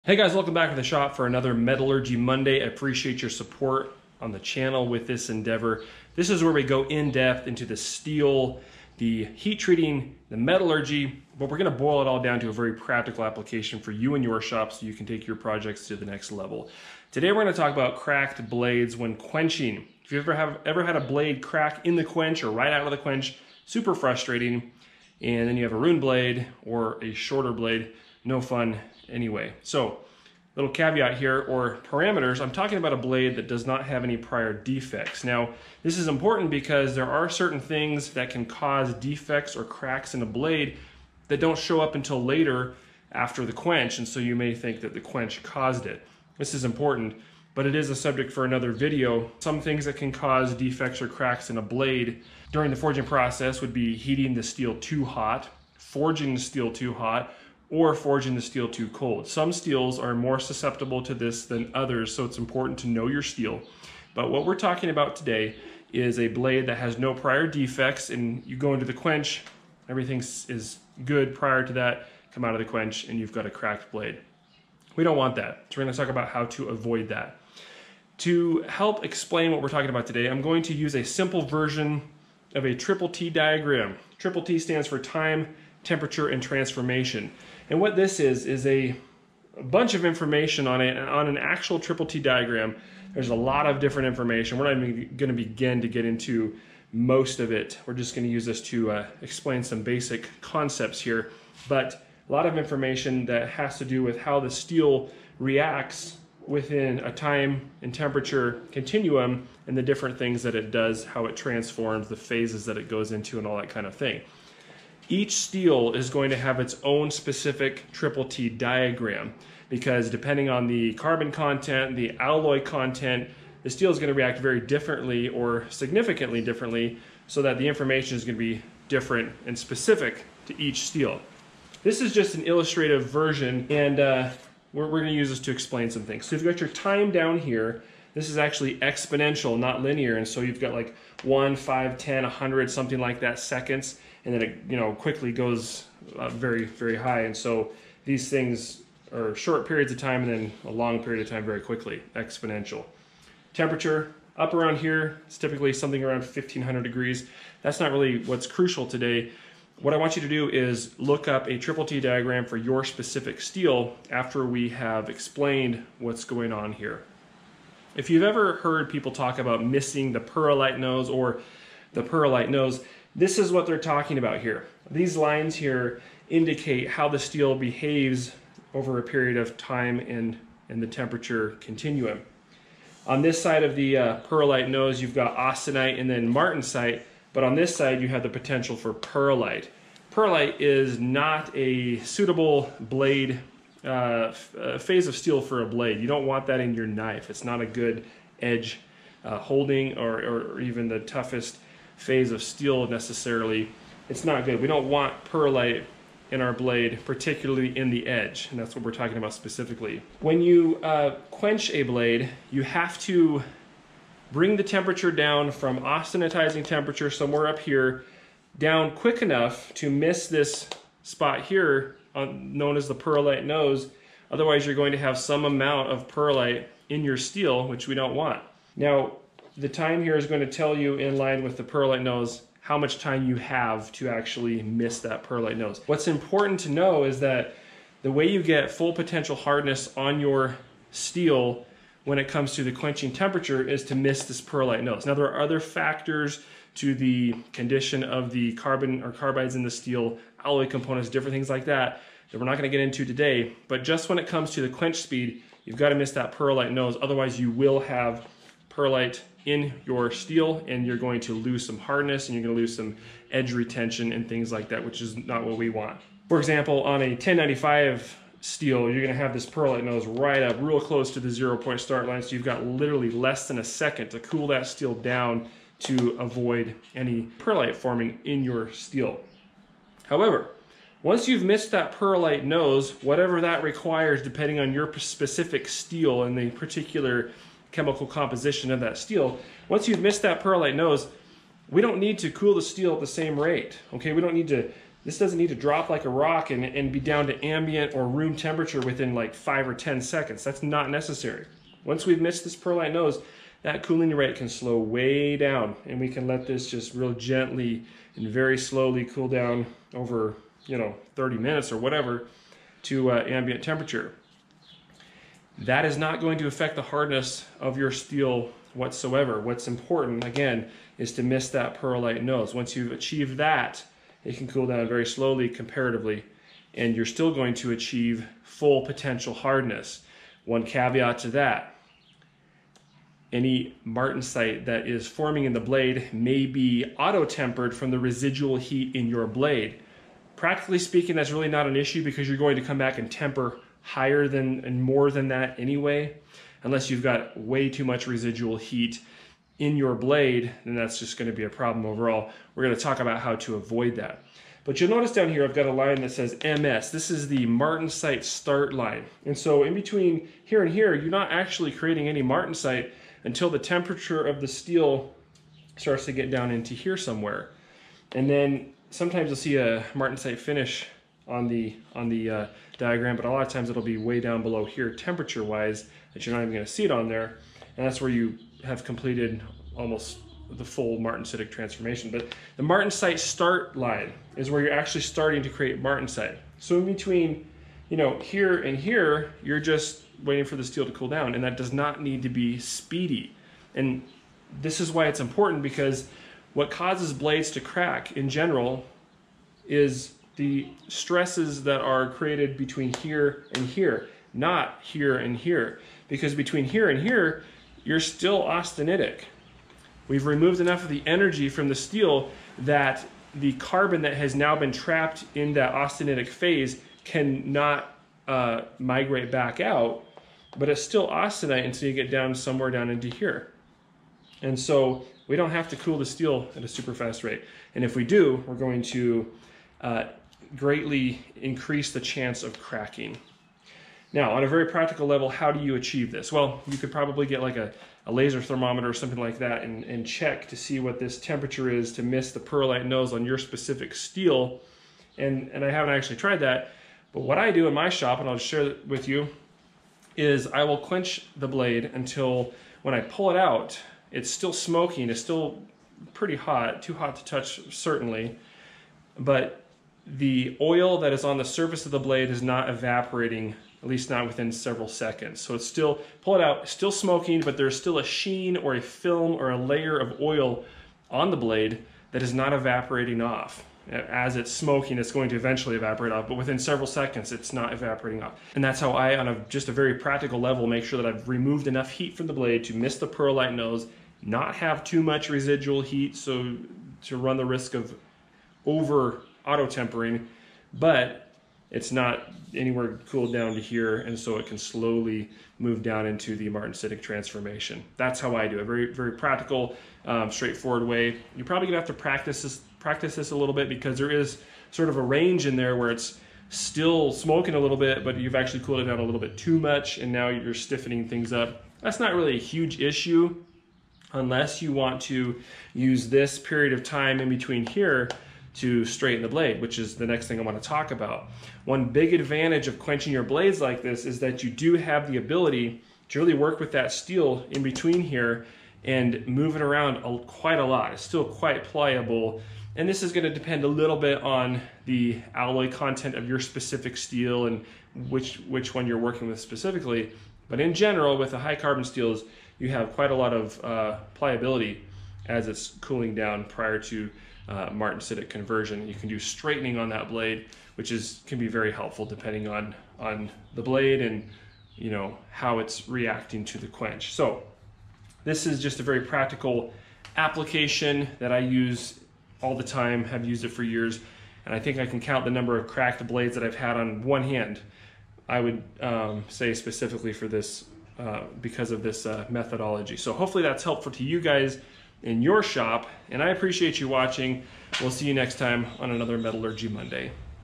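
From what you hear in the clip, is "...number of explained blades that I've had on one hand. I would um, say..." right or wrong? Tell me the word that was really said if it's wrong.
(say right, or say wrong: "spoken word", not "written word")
wrong: "cracked", not "explained".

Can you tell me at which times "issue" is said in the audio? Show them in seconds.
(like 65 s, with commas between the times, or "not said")
341 s, 512 s.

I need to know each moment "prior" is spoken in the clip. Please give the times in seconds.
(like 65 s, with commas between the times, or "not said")
34 s, 67 s, 71 s, 546 s.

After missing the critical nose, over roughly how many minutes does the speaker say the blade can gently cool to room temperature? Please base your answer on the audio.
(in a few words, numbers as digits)
30 minutes.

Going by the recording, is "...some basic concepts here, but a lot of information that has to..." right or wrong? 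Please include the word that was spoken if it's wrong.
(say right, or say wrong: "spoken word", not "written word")
right.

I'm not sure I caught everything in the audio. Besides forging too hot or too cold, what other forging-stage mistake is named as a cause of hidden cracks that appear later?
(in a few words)
Heating the steel too hot.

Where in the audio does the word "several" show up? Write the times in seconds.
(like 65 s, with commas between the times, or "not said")
464 s, 476 s.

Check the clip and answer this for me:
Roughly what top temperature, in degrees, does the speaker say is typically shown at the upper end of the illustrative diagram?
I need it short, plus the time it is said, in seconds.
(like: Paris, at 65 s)
1500, at 156 s.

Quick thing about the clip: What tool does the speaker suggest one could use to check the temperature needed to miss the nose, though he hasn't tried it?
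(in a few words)
Laser thermometer.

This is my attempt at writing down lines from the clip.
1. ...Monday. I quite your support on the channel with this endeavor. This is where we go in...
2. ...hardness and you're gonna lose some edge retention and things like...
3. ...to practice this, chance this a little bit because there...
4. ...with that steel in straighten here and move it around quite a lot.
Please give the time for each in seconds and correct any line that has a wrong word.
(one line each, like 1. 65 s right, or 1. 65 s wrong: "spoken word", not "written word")
1. 2 s wrong: "appreciate", not "quite"
2. 261 s right
3. 501 s wrong: "practice", not "chance"
4. 526 s wrong: "between", not "straighten".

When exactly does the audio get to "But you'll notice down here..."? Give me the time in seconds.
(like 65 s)
354 s.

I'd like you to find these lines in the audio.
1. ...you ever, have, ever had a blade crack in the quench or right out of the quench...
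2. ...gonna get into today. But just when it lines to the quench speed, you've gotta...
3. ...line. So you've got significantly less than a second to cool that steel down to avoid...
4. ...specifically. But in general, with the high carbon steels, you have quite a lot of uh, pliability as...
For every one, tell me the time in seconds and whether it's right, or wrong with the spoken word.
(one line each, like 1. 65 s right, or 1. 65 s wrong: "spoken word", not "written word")
1. 20 s right
2. 252 s wrong: "comes", not "lines"
3. 272 s wrong: "literally", not "significantly"
4. 539 s right.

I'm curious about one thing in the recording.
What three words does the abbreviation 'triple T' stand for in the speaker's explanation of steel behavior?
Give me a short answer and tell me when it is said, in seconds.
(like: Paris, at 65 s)
Time, temperature, and transformation, at 84 s.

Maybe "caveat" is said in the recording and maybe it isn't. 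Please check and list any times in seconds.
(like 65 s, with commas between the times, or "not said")
30 s, 330 s.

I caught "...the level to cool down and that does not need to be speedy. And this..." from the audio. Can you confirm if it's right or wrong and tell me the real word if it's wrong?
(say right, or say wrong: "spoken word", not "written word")
wrong: "steel", not "level".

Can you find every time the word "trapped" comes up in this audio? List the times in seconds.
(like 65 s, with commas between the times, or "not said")
414 s.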